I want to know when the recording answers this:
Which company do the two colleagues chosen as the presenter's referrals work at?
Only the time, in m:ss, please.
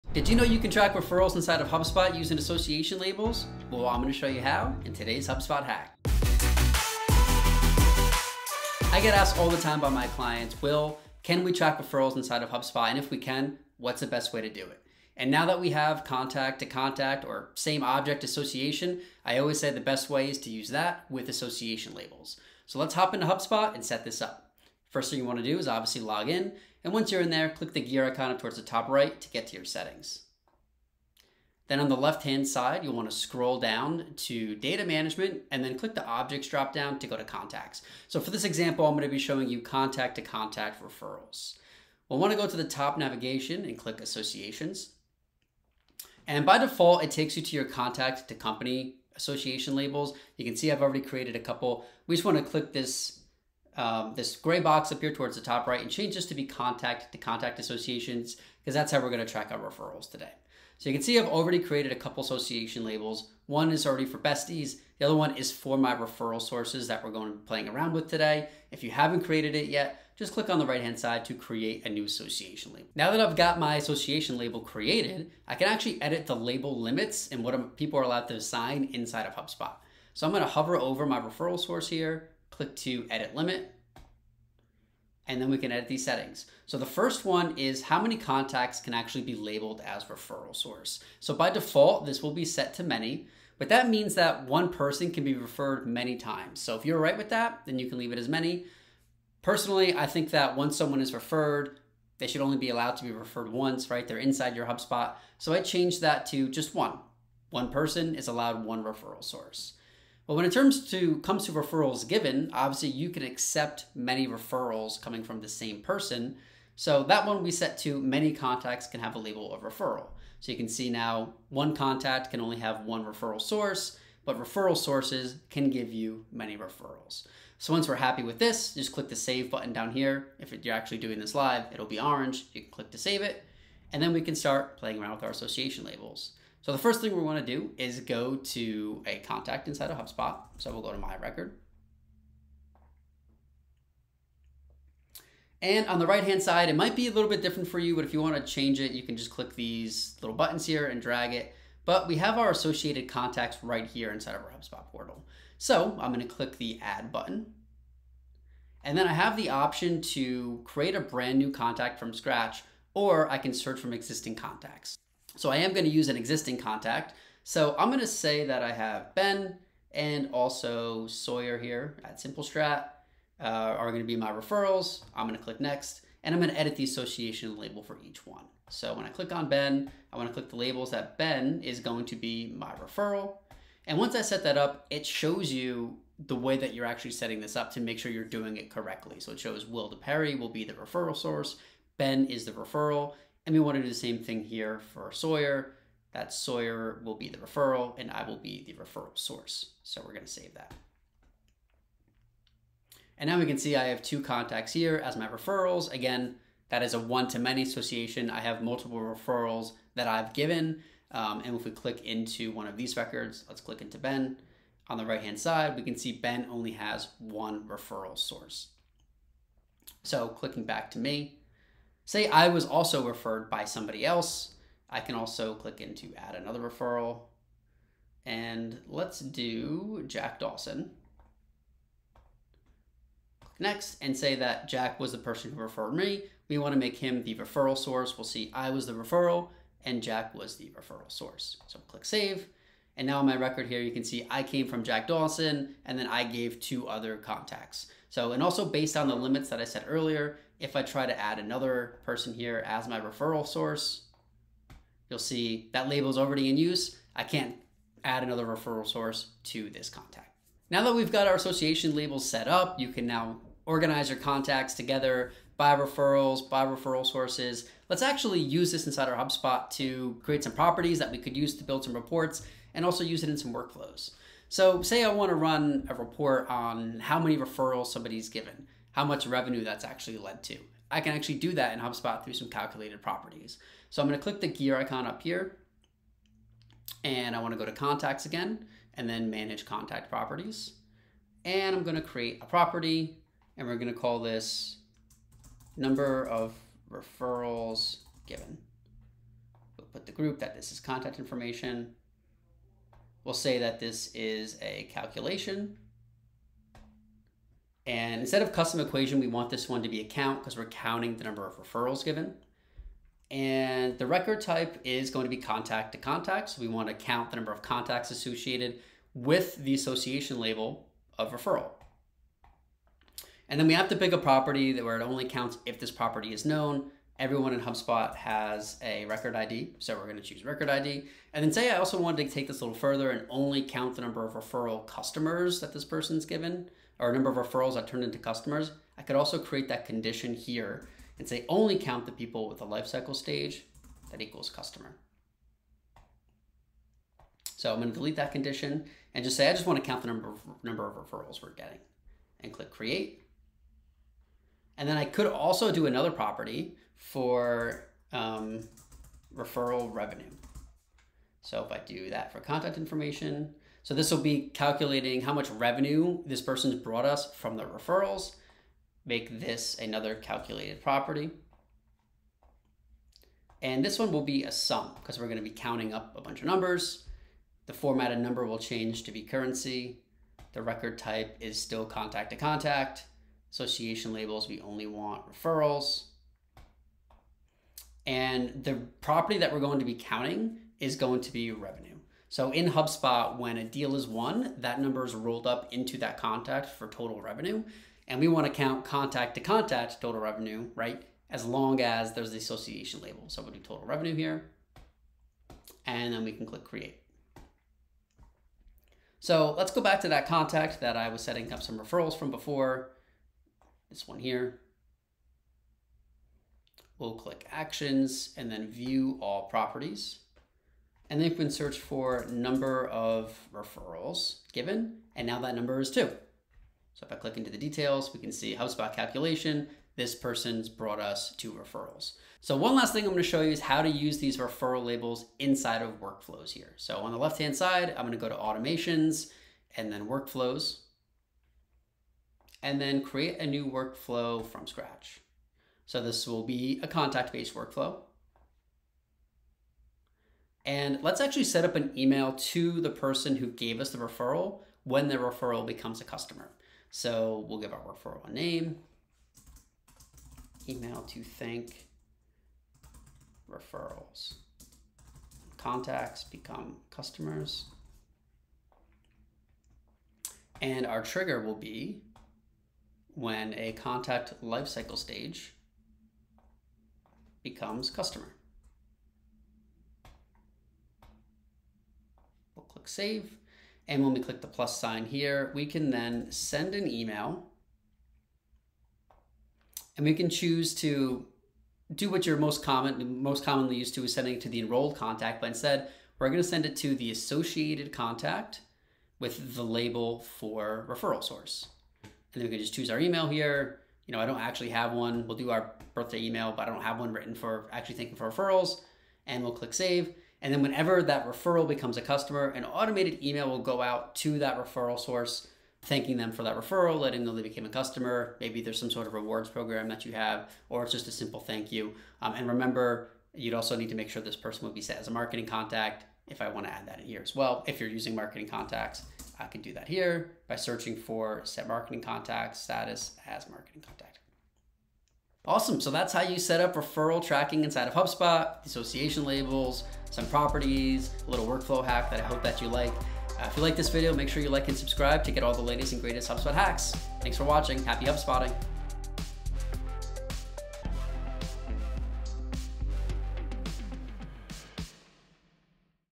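2:52.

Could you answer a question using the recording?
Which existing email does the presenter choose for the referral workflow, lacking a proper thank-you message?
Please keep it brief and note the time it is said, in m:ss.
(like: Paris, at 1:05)
Birthday email, at 8:25.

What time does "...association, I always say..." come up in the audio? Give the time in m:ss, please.
0:18.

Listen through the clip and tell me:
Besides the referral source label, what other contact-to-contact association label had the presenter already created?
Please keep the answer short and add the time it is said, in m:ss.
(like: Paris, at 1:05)
Besties, at 1:04.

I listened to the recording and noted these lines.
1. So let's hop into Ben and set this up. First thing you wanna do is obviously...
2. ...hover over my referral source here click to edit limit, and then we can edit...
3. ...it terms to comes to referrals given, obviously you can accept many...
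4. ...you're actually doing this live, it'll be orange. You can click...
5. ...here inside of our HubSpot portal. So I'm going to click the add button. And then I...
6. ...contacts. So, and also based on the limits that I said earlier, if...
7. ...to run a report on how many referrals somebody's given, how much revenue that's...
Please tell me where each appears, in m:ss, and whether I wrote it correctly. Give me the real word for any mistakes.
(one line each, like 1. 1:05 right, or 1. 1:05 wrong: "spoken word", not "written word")
1. 0:22 wrong: "HubSpot", not "Ben"
2. 1:20 right
3. 1:50 right
4. 2:10 right
5. 2:33 right
6. 4:07 right
7. 4:35 right.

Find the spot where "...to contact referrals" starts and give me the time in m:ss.
0:40.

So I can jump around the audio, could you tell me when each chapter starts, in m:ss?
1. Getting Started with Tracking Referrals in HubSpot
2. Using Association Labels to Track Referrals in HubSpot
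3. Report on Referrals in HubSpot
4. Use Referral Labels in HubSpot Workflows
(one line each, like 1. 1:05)
1. 0:24
2. 2:16
3. 4:34
4. 7:13.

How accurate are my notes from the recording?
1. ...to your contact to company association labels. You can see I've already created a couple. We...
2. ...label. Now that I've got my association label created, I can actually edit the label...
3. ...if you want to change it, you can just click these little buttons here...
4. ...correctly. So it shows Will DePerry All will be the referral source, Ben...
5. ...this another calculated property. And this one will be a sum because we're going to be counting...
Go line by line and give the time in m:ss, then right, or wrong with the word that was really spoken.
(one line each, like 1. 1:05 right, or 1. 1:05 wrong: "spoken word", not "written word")
1. 0:47 right
2. 1:12 right
3. 2:28 right
4. 3:08 wrong: "Perry", not "All"
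5. 6:09 right.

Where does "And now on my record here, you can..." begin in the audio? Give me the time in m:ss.
4:02.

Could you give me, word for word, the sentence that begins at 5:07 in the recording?
And instead of custom equation, we want this one to be a count because we're counting the number of referrals given.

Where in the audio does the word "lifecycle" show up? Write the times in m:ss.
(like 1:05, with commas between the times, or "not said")
5:42, 7:54.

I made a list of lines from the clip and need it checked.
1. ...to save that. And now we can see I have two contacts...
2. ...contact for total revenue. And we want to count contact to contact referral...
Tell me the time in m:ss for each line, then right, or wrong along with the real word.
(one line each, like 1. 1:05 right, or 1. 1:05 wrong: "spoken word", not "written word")
1. 3:20 right
2. 6:36 wrong: "total", not "referral".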